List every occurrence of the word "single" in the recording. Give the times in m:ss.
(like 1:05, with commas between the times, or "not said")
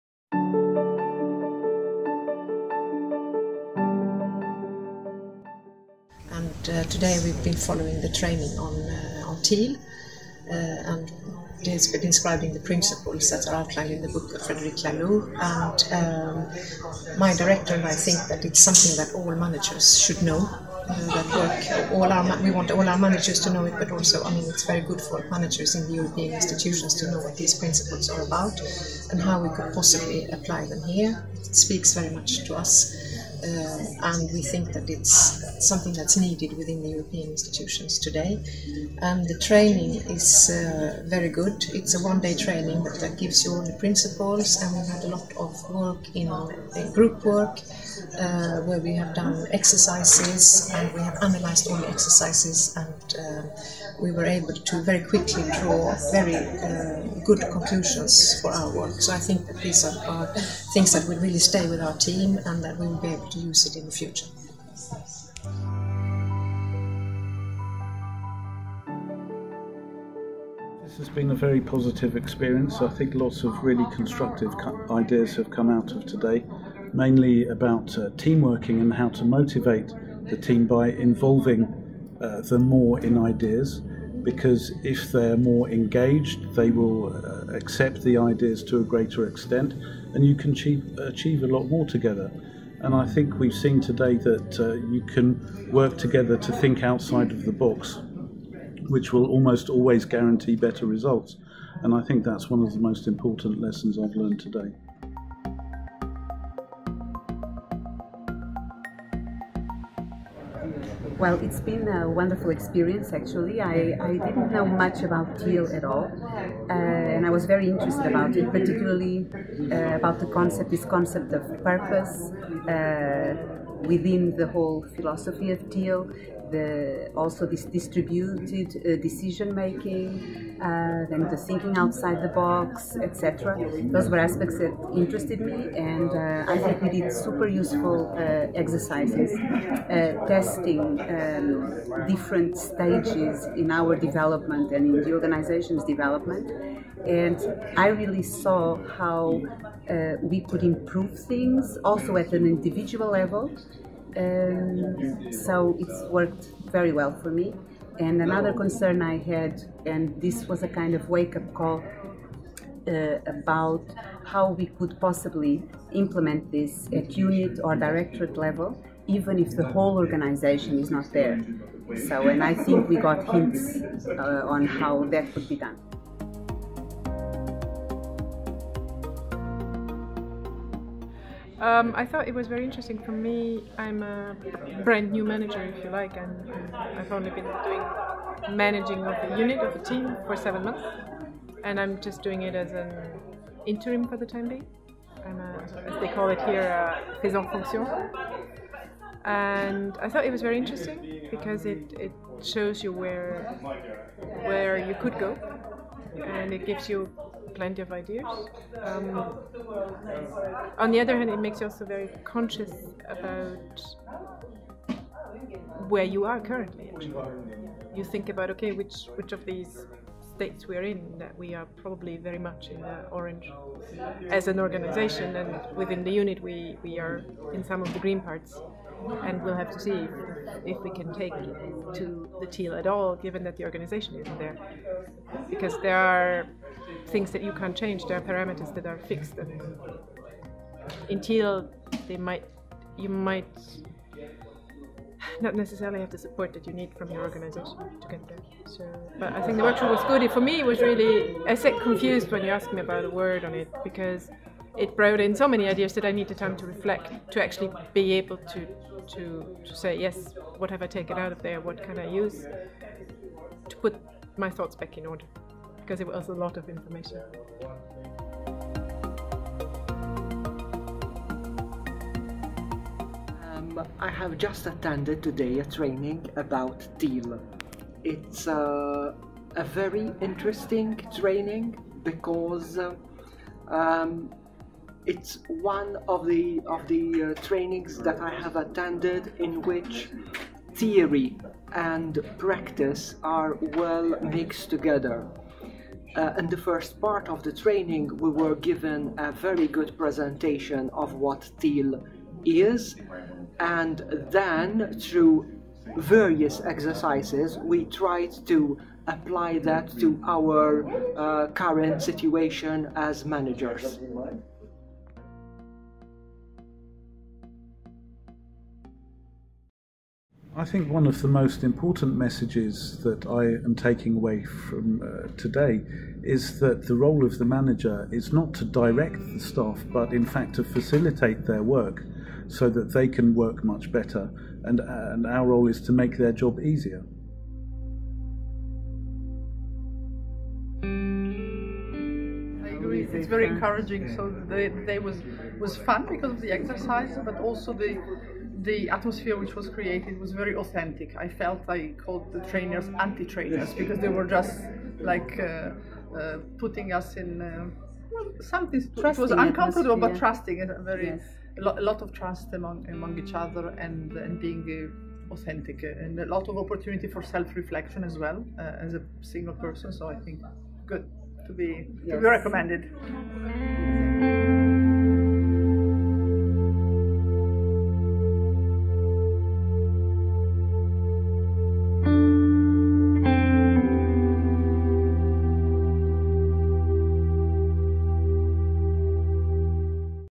6:09.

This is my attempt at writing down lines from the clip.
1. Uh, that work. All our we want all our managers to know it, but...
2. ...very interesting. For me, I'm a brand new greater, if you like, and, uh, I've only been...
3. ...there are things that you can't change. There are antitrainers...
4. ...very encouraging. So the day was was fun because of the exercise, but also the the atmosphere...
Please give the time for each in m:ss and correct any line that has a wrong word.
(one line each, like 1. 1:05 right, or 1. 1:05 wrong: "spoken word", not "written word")
1. 0:20 right
2. 3:02 wrong: "manager", not "greater"
3. 3:55 wrong: "parameters", not "antitrainers"
4. 5:43 right.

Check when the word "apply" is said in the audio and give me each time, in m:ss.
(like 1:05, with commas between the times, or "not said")
0:30, 5:09.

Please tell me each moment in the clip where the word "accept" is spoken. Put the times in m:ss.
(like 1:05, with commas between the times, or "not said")
1:27.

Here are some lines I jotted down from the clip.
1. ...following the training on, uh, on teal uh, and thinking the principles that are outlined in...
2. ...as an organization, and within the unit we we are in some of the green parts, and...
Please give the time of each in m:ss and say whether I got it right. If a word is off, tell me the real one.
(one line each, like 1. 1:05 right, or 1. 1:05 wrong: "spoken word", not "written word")
1. 0:07 wrong: "describing", not "thinking"
2. 3:44 right.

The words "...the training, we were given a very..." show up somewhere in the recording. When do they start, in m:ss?
4:57.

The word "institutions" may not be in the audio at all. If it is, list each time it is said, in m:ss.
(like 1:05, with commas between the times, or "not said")
0:26, 0:37.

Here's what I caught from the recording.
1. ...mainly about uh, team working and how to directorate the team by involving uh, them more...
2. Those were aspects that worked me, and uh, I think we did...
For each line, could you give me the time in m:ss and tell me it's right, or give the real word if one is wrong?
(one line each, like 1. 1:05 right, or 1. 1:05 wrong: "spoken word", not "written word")
1. 1:16 wrong: "motivate", not "directorate"
2. 2:13 wrong: "interested", not "worked".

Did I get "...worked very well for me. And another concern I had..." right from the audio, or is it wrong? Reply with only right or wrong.
right.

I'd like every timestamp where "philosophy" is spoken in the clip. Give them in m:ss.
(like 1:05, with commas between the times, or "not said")
2:04.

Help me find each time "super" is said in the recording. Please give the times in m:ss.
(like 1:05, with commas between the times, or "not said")
2:17.